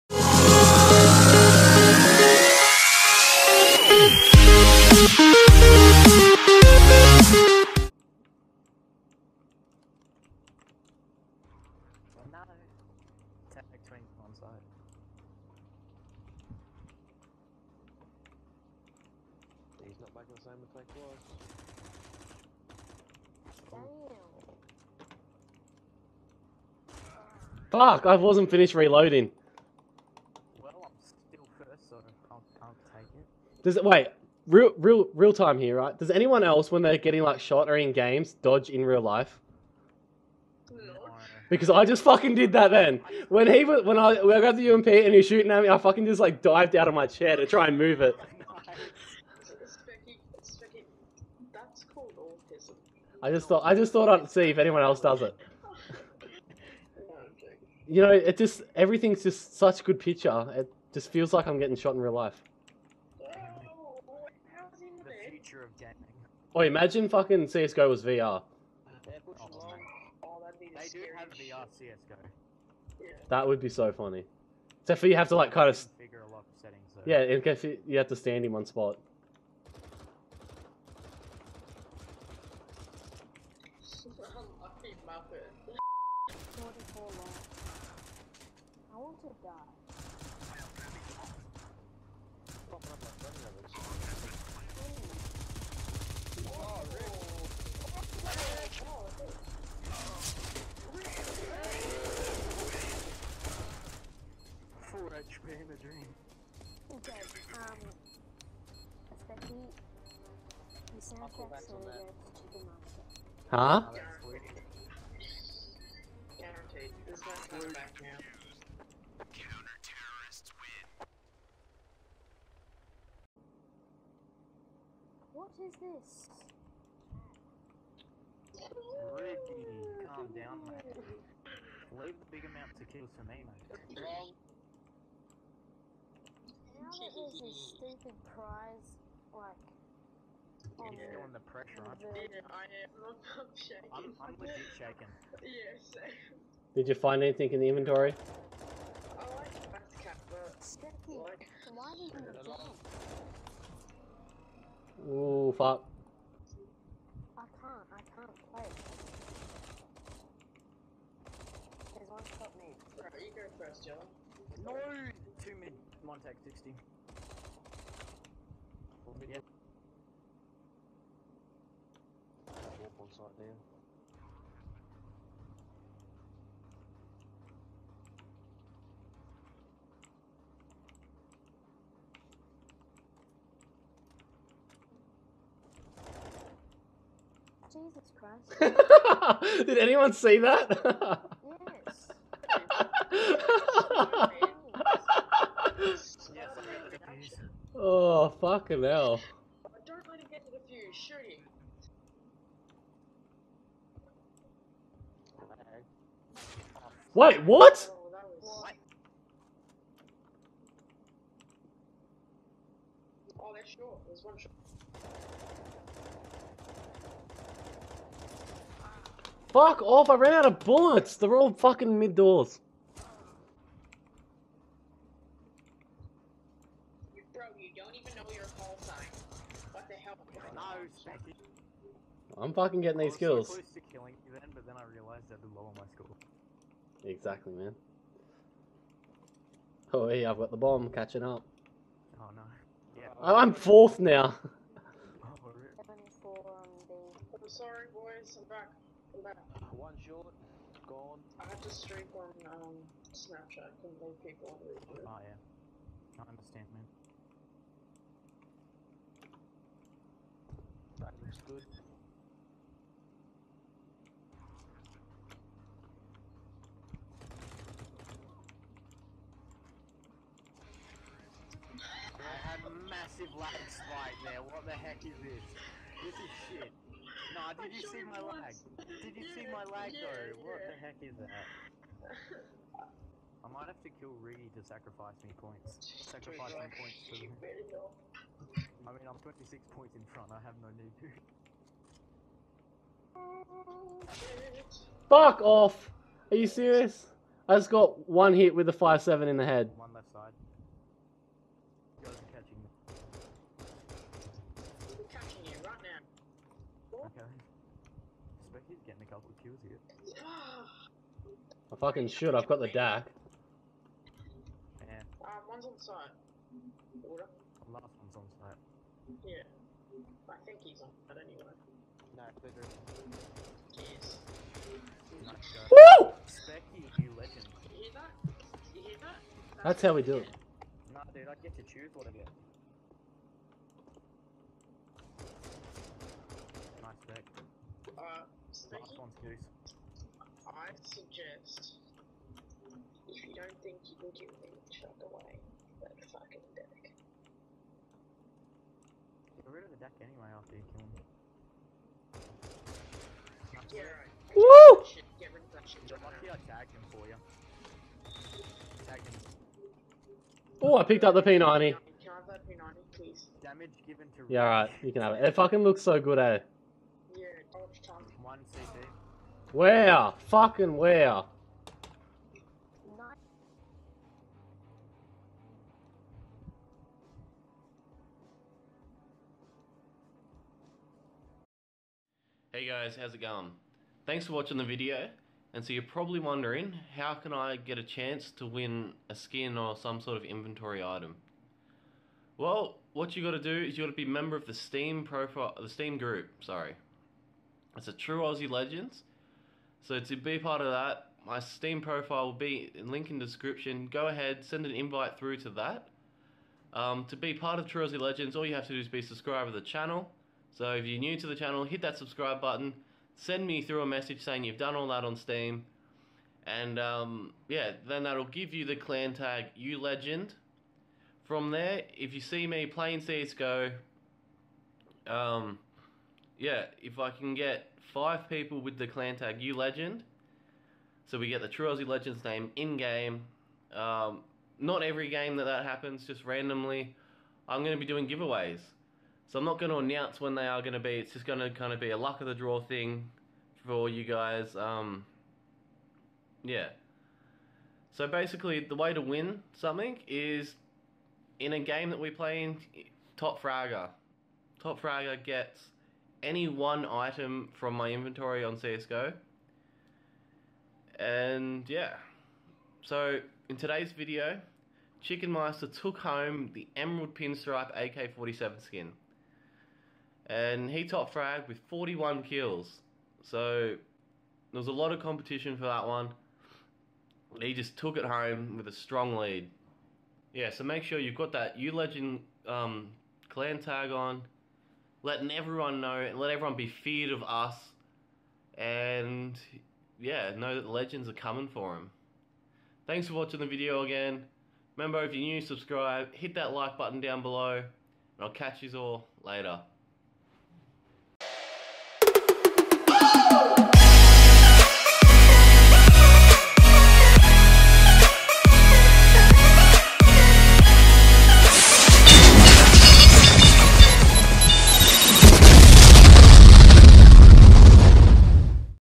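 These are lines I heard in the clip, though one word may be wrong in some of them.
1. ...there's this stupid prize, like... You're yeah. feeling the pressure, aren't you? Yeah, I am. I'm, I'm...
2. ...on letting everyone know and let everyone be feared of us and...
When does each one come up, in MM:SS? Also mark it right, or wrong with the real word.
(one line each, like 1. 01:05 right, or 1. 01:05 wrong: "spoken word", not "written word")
1. 02:17 right
2. 08:03 right.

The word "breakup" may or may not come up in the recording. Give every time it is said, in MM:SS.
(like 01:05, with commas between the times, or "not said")
not said.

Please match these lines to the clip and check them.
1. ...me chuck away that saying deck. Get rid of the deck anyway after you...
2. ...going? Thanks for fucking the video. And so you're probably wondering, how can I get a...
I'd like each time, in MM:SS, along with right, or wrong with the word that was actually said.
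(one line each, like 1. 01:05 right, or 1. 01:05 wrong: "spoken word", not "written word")
1. 05:44 wrong: "fucking", not "saying"
2. 06:23 wrong: "watching", not "fucking".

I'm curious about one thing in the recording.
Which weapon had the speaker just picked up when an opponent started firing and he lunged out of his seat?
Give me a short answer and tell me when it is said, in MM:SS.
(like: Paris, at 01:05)
UMP, at 00:44.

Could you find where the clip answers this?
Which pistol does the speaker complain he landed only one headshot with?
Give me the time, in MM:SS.
04:58.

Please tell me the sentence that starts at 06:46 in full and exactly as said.
Um, to be part of True Aussie Legends, all you have to do is be subscribed to the channel.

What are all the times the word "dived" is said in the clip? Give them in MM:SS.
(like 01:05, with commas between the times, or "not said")
00:46.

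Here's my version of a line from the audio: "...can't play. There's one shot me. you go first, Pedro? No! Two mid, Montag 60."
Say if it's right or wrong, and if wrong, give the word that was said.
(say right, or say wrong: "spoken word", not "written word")
wrong: "Joe", not "Pedro".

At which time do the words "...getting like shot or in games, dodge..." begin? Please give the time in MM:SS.
00:36.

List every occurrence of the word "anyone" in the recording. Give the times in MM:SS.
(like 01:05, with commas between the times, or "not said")
00:36, 00:54, 03:09.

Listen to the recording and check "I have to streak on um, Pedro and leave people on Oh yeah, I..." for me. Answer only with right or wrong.
wrong.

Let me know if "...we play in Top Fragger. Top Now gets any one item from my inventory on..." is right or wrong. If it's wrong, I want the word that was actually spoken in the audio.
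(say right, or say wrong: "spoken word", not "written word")
wrong: "Fragger", not "Now".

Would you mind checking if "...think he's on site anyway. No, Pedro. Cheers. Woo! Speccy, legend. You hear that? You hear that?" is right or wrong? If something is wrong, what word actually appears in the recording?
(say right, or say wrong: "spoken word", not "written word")
right.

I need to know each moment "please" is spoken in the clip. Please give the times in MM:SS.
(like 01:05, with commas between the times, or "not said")
06:02.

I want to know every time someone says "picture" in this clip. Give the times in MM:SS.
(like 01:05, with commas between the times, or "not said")
00:59.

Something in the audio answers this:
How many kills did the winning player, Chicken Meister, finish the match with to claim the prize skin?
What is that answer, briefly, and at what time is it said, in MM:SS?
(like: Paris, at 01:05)
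41, at 07:51.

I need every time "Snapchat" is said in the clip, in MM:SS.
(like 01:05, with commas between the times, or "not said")
04:13.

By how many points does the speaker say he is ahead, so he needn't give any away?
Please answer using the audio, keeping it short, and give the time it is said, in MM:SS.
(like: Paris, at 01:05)
26, at 04:49.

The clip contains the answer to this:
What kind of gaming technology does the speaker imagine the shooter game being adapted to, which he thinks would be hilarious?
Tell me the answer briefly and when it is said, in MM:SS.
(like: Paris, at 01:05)
VR, at 01:08.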